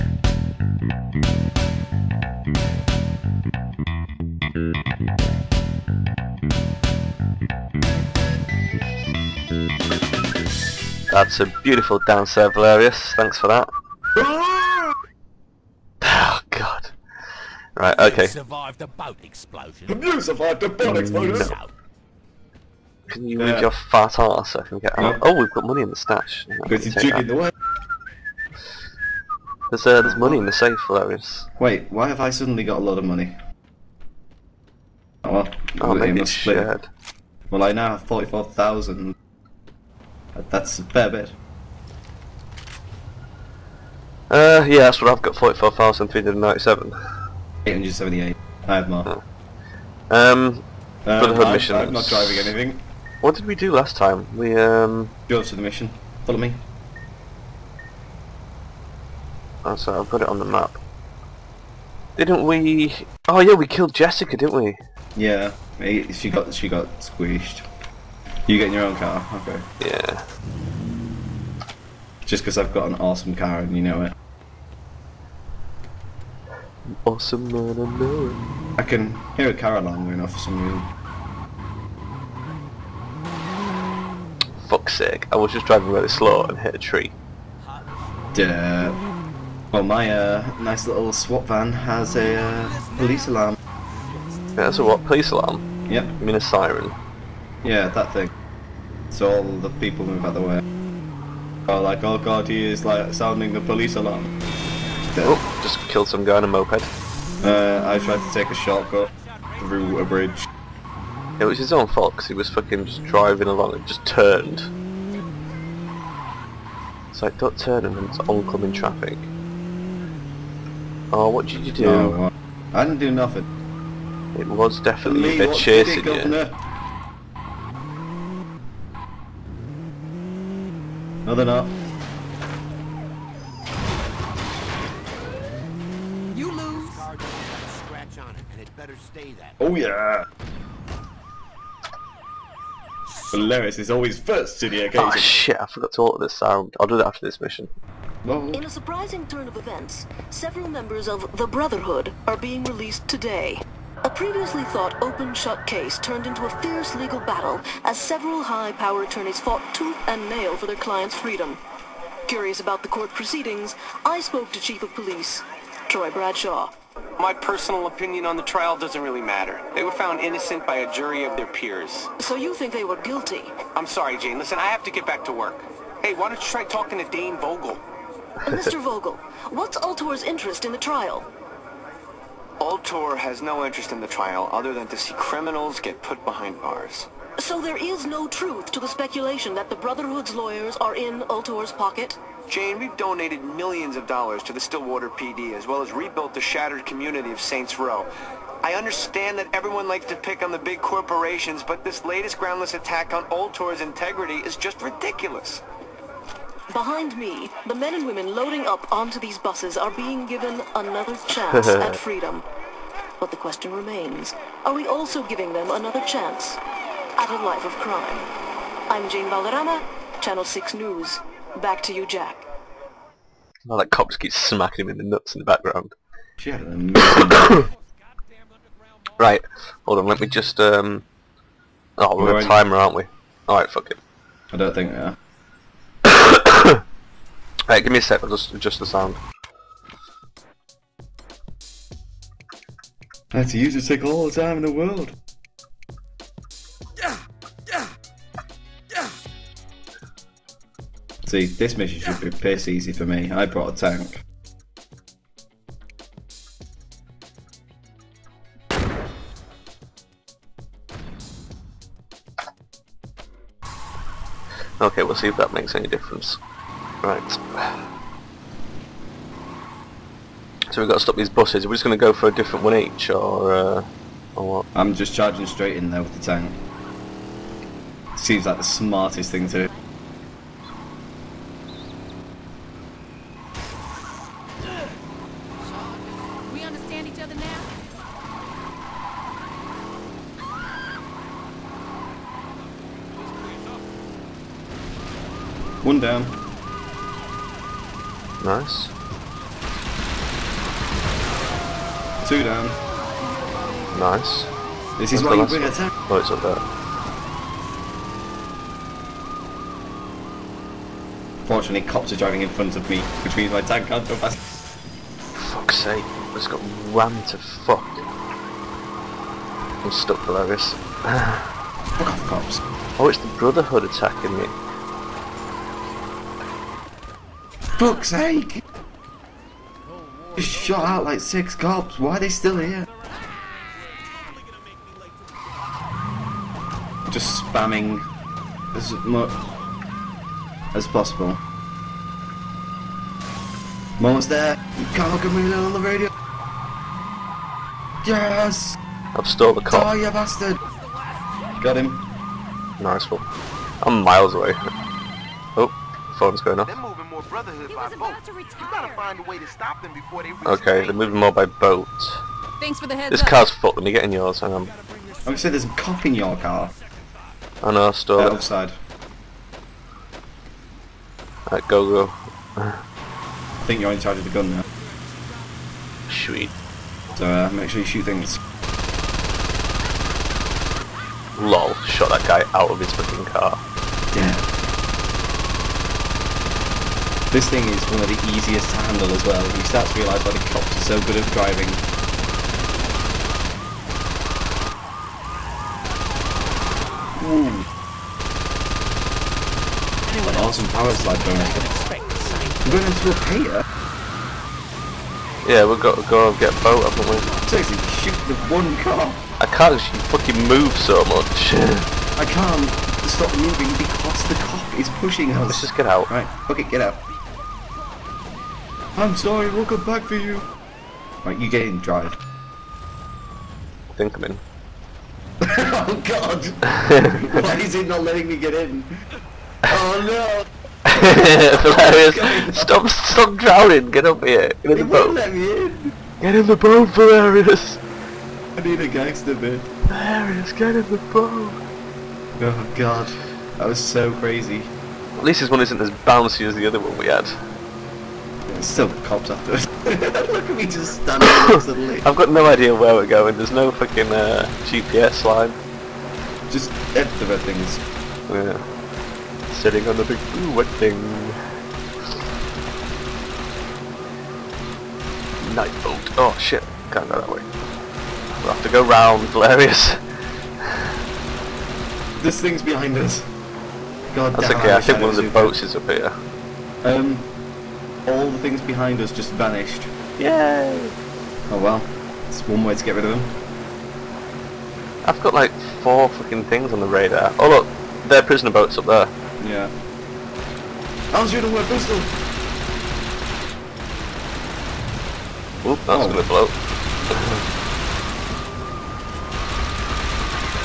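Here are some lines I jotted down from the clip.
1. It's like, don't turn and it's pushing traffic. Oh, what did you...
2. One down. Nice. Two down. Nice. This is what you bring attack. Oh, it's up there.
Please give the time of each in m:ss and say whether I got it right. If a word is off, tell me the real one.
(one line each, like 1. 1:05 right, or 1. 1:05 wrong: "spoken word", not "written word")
1. 1:57 wrong: "oncoming", not "pushing"
2. 4:55 right.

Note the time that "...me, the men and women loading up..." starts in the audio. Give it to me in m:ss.
3:27.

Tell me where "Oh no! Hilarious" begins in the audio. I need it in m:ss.
7:09.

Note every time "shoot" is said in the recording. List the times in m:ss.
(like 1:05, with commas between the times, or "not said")
6:17, 6:47.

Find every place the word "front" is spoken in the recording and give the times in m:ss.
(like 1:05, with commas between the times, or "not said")
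5:12.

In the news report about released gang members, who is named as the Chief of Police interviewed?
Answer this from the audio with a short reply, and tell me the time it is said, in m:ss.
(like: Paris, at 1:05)
Troy Bradshaw, at 2:45.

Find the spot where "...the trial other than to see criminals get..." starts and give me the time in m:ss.
3:03.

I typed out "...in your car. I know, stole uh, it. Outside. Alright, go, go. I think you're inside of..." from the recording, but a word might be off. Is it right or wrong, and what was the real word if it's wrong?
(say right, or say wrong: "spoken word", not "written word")
right.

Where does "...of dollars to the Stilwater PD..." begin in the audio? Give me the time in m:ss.
3:13.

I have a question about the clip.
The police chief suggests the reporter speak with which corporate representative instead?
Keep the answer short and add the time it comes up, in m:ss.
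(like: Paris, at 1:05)
Dane Vogel, at 2:57.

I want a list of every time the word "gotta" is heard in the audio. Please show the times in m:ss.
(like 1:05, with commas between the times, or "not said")
5:58.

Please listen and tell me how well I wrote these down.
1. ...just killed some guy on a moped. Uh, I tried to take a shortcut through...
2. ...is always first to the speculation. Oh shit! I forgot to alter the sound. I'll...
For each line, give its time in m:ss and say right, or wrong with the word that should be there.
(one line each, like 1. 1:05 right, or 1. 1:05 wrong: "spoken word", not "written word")
1. 1:45 right
2. 2:23 wrong: "occasion", not "speculation".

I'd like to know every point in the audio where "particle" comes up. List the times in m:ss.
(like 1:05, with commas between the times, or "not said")
not said.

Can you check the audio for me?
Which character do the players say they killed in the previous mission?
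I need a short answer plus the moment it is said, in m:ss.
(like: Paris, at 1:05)
Jessica, at 1:03.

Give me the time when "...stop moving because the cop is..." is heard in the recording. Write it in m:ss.
6:53.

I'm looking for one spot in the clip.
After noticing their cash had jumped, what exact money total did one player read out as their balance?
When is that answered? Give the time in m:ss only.
0:45.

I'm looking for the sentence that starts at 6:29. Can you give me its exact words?
You start to realise why the cops are so good at driving.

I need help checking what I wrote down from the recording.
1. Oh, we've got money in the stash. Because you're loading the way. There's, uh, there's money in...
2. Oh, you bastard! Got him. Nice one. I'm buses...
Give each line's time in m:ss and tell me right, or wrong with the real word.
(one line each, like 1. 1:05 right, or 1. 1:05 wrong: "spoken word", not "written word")
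1. 0:25 wrong: "jigging", not "loading"
2. 5:49 wrong: "miles", not "buses".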